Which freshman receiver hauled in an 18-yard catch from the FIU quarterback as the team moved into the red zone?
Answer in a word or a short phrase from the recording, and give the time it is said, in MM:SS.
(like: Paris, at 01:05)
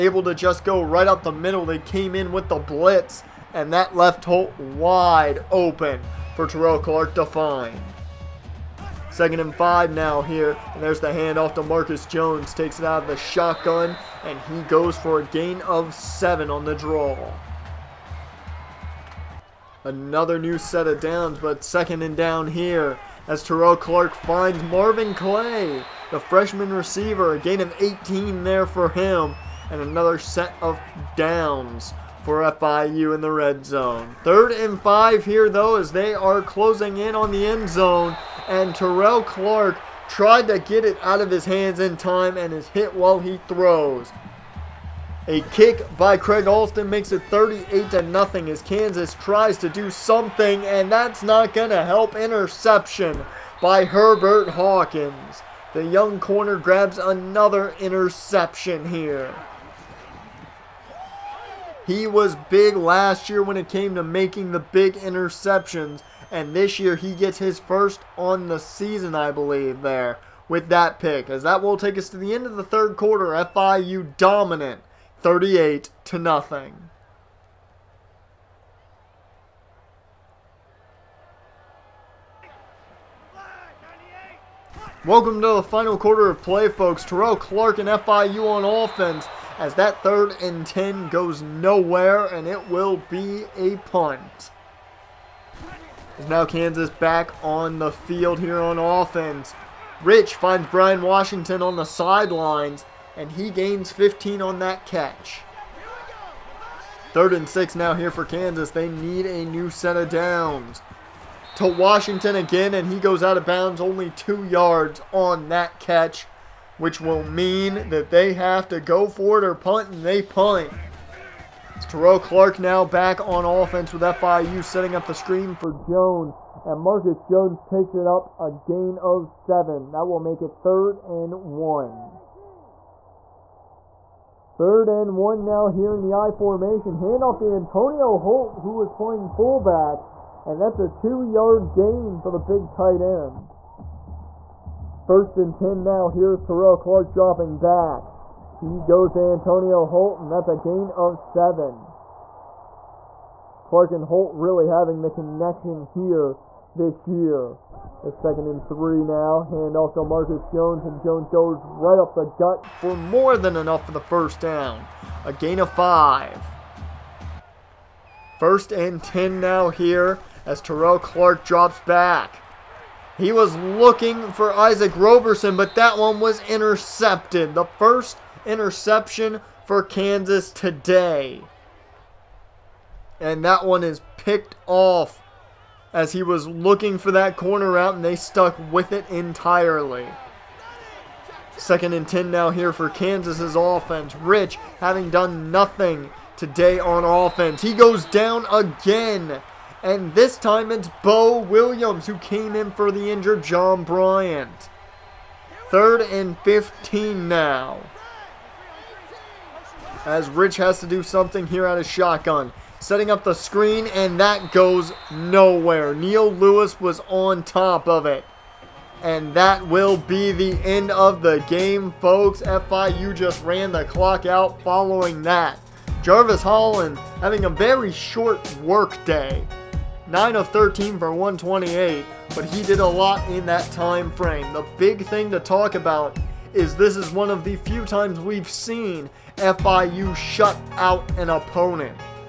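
Marvin Clay, at 00:24.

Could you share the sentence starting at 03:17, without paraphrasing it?
He goes down again and this time it's Bo Williams who came in for the injured John Bryant.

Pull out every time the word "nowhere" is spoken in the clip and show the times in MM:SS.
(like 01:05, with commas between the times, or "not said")
01:31, 03:35.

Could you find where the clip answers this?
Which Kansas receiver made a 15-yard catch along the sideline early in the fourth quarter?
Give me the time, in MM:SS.
01:40.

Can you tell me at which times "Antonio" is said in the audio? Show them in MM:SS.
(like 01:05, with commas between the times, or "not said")
02:17, 02:29.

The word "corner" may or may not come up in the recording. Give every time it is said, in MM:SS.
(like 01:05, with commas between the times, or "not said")
00:56, 03:07.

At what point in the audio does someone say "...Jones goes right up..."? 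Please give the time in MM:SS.
02:40.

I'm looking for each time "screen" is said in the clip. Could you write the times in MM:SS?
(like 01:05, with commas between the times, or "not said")
02:05, 03:33.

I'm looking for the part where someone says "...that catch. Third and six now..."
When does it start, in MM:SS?
01:44.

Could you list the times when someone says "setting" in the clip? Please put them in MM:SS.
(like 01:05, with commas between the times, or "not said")
02:04, 03:32.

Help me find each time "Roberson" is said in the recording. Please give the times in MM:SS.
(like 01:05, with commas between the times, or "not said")
02:54.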